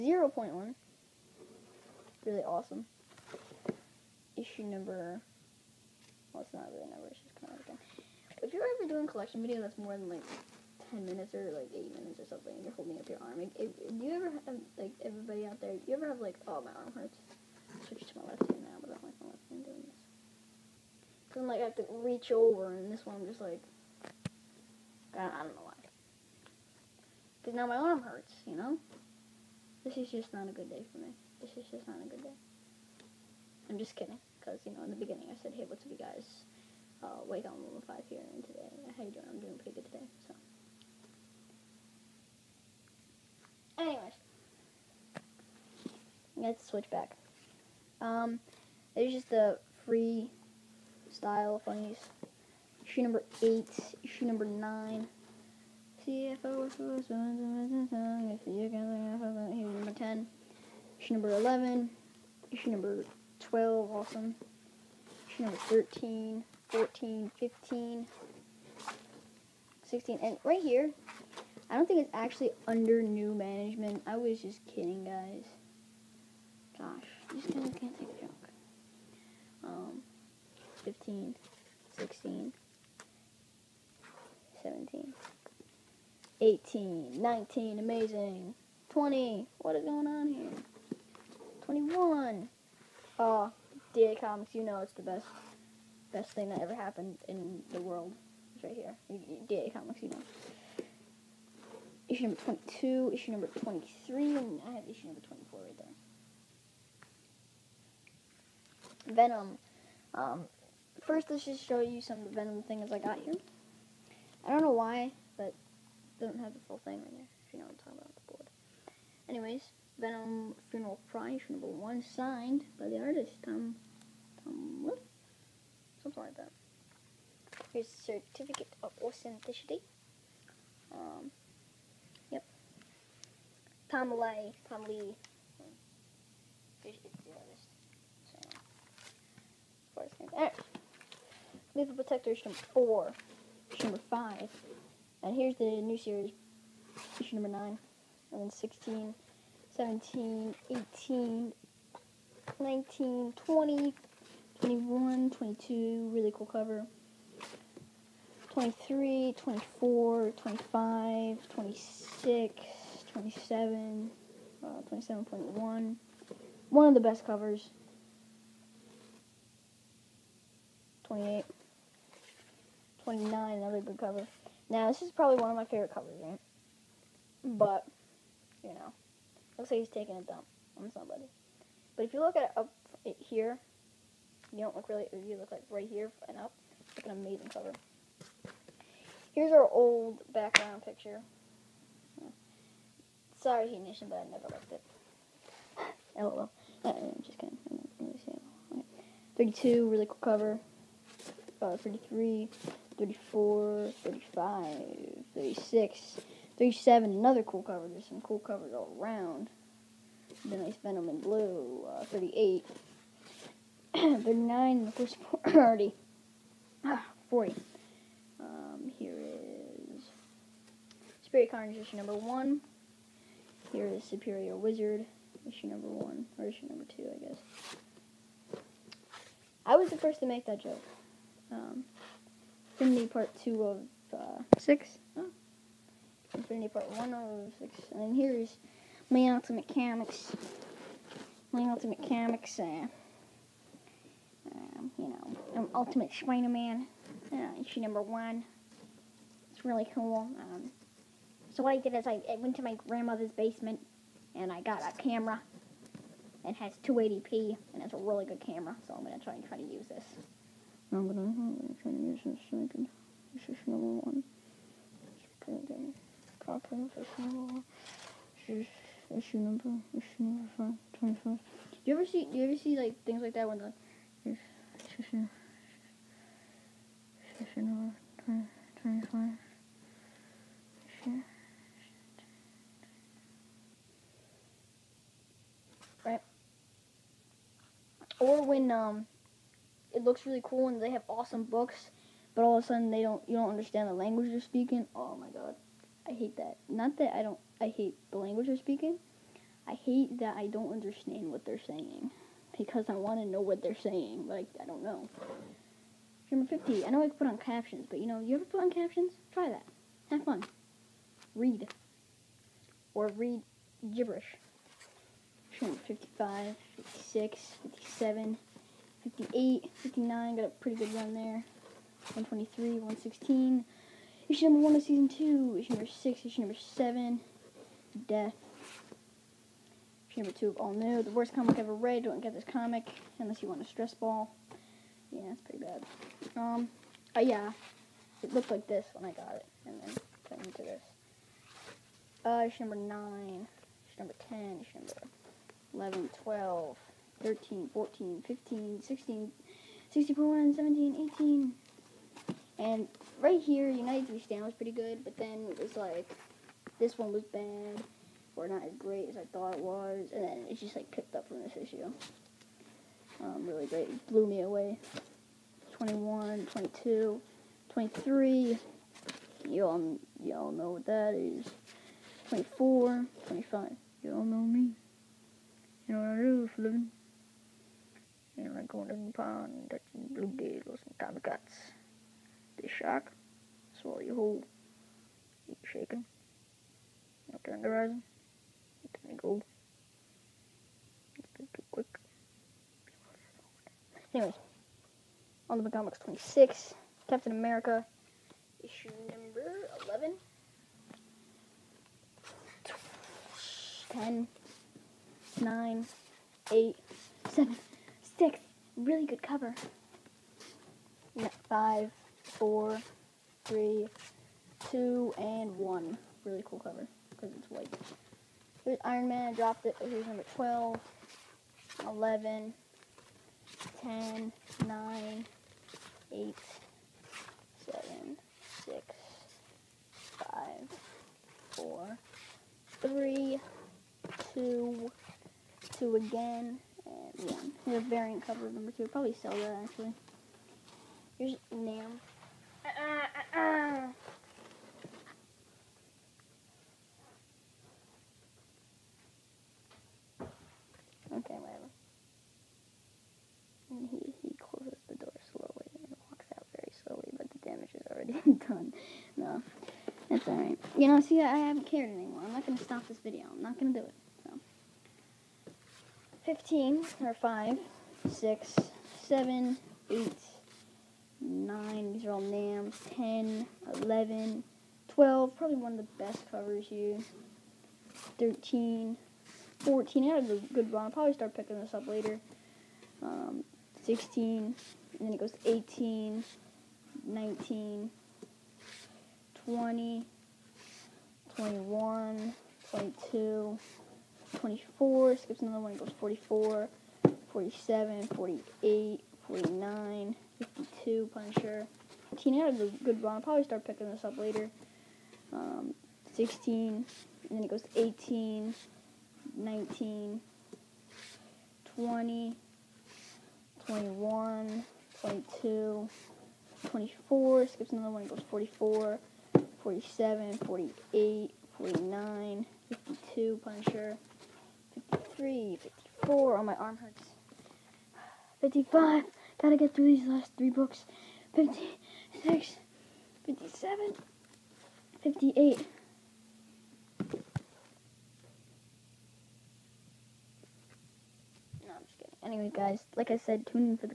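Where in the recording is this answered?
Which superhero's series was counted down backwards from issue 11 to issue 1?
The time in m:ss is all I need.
6:37.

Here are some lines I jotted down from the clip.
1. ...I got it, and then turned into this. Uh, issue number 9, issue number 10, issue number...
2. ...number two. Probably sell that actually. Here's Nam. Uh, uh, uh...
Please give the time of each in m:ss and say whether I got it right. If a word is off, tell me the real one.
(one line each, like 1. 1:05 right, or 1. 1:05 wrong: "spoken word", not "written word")
1. 5:39 right
2. 7:18 right.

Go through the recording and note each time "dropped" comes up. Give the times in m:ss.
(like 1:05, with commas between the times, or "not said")
6:59.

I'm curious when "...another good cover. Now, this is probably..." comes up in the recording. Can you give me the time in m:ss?
2:53.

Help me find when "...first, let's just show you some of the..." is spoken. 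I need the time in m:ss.
1:51.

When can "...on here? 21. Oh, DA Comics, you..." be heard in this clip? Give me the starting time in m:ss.
1:30.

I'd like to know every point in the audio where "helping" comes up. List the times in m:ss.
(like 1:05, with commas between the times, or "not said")
not said.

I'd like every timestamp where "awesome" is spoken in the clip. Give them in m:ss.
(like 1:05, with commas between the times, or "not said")
0:02, 1:03, 4:51.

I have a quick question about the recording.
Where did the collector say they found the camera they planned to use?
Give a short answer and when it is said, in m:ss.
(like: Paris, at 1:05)
grandmother's basement, at 4:12.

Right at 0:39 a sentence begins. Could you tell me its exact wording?
I'm doing pretty good today, so.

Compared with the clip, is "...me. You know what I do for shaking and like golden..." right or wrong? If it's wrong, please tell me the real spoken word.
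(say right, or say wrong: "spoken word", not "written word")
wrong: "living", not "shaking".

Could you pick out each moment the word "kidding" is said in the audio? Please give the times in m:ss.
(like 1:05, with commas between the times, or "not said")
0:33, 1:14, 3:17, 9:01.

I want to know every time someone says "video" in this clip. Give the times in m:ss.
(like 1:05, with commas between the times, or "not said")
0:09, 7:42.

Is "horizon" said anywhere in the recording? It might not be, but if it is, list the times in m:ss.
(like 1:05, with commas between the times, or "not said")
6:27.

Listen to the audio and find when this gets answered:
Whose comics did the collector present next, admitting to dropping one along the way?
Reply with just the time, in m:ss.
6:58.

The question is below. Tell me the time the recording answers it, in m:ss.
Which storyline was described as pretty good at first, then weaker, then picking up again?
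5:53.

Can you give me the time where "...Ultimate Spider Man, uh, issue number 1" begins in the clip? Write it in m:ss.
4:05.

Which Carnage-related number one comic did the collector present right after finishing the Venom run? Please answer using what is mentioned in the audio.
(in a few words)
Spirit Carnage.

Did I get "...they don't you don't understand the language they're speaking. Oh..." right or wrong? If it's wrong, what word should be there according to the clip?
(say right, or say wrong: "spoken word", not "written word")
right.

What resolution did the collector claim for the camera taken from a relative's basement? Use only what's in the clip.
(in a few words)
280p.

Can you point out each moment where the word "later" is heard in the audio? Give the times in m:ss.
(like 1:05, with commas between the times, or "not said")
8:01.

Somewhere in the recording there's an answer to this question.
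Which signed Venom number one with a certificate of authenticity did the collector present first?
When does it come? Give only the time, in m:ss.
2:00.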